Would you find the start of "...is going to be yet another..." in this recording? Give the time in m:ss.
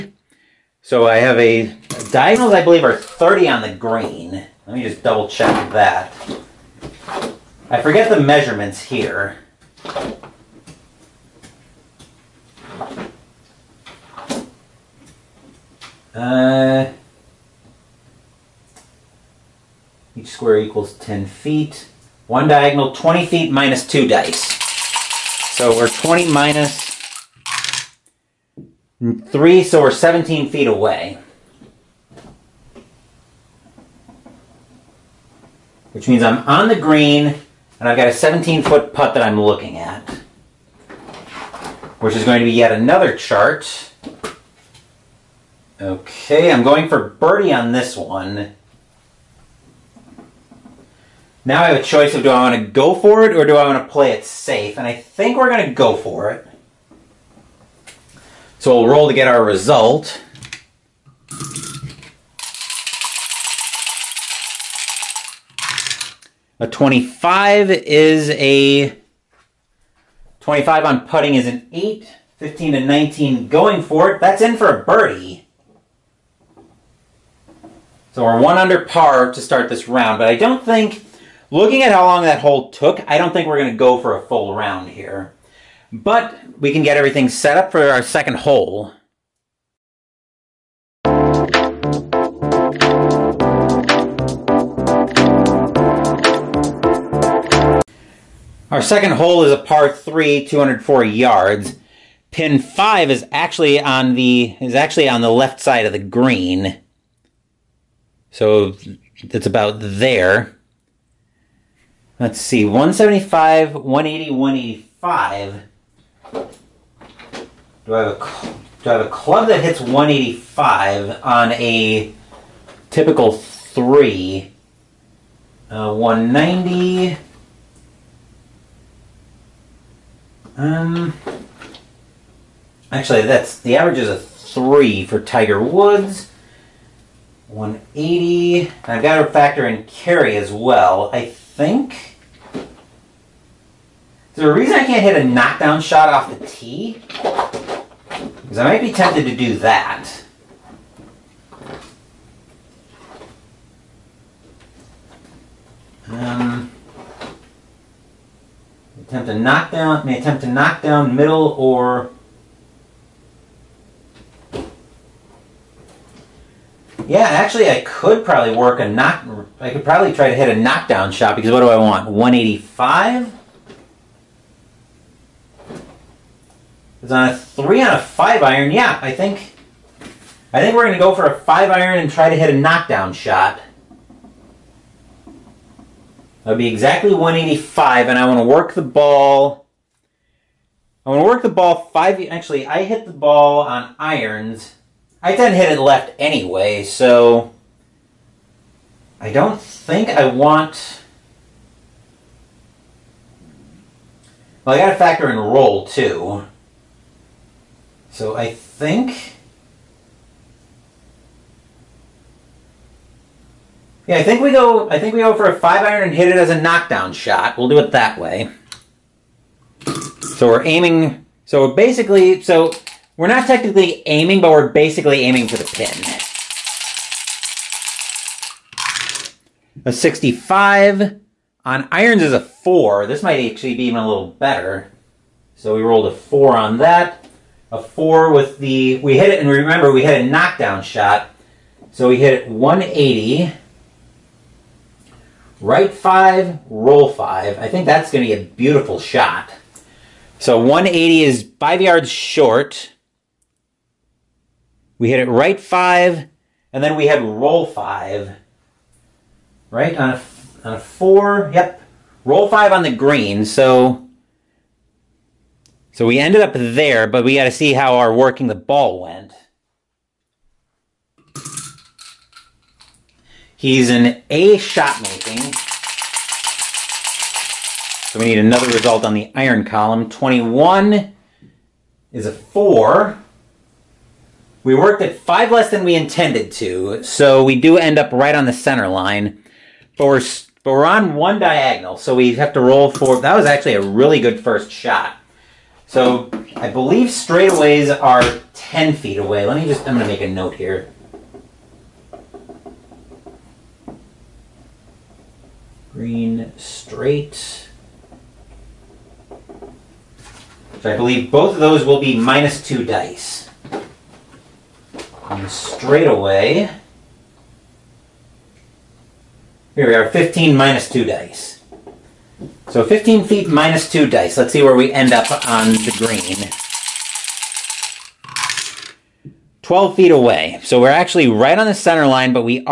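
0:42.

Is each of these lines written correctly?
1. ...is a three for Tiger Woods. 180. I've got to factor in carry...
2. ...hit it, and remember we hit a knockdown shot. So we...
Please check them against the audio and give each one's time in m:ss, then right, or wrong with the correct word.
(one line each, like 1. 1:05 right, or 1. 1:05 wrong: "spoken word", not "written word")
1. 2:13 right
2. 3:59 right.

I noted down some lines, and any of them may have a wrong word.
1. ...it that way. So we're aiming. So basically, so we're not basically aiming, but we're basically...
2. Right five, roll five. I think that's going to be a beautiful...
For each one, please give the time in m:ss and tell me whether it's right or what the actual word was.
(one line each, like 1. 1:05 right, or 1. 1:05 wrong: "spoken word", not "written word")
1. 3:37 wrong: "technically", not "basically"
2. 4:05 right.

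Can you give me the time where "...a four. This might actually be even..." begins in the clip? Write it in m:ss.
3:52.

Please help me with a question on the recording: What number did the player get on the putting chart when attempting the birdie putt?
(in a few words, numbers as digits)
8.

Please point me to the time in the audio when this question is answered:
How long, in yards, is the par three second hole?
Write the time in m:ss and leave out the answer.
1:40.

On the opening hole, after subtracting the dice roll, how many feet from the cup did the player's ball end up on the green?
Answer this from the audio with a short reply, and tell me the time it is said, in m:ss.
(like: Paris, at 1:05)
17 feet, at 0:29.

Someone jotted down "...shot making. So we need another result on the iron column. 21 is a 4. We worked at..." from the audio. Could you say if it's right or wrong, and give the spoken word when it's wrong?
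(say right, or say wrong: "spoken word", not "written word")
right.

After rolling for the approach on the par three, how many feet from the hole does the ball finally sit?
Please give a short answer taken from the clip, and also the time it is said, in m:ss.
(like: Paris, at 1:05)
12 feet, at 5:29.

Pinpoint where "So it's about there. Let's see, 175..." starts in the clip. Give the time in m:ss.
1:48.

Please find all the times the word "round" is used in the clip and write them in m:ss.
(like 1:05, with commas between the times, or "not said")
1:19, 1:24.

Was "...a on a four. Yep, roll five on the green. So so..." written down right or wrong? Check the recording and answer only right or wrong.
right.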